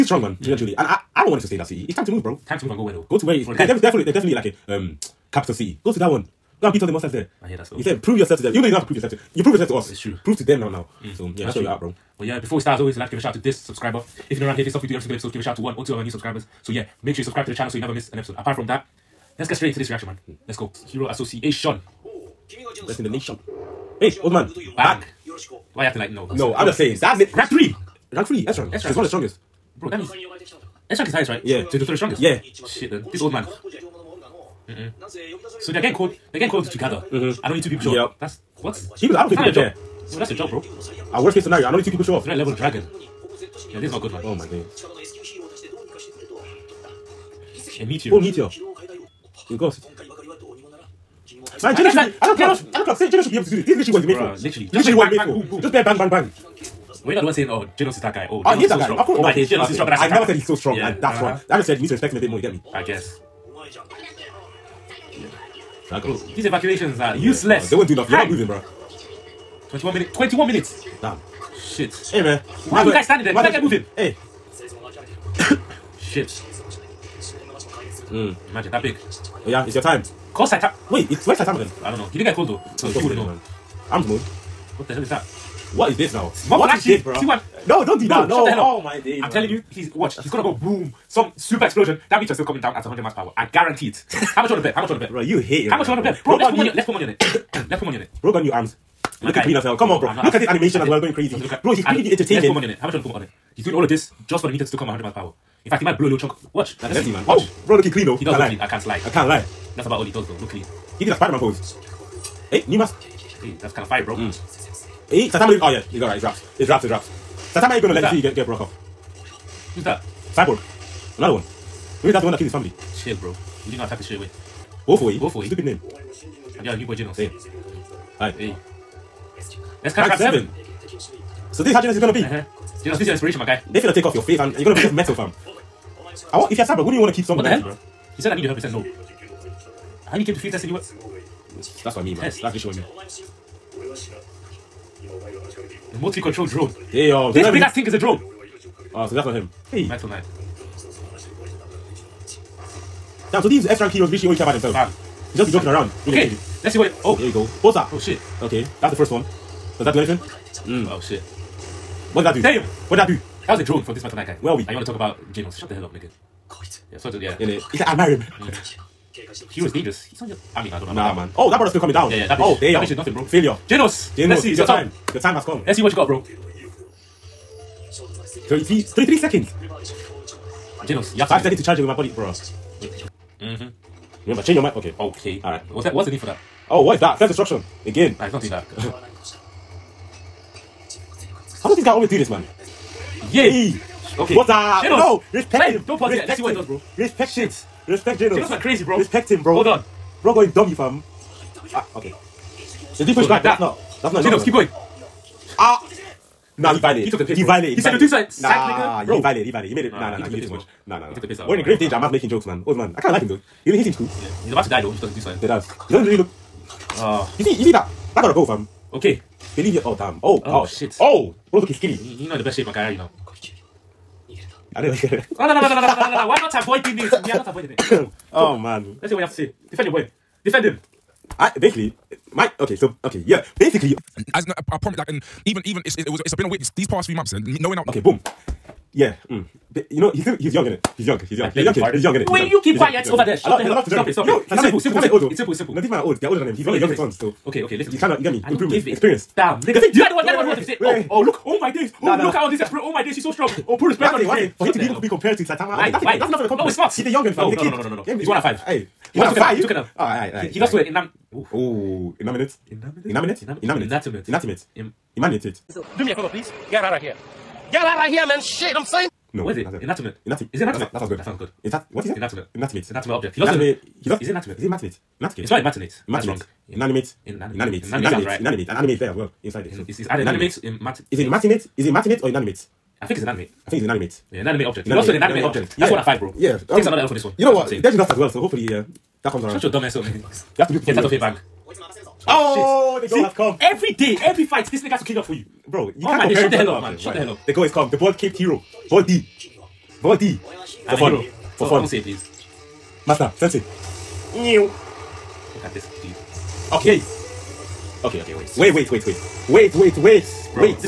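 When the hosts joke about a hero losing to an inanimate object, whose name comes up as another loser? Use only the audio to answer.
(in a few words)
Deji.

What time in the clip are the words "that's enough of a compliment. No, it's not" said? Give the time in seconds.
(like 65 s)
256 s.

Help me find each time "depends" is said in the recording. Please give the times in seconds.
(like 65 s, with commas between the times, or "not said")
not said.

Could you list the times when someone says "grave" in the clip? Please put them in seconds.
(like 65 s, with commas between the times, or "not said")
211 s.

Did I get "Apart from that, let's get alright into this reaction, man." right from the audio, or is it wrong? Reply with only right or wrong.
wrong.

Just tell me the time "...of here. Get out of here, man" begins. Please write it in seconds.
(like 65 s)
266 s.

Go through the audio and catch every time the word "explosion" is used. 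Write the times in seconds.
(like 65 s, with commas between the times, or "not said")
91 s.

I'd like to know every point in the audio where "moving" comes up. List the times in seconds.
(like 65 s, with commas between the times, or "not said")
68 s, 73 s.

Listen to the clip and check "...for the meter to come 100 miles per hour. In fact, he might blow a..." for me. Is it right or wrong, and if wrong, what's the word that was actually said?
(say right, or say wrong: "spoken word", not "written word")
right.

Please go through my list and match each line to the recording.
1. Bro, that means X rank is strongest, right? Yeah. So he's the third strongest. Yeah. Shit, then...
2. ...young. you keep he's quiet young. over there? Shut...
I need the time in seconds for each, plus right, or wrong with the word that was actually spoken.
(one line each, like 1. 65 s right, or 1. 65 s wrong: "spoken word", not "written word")
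1. 29 s wrong: "highest", not "strongest"
2. 242 s right.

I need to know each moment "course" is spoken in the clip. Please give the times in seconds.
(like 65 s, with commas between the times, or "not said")
59 s.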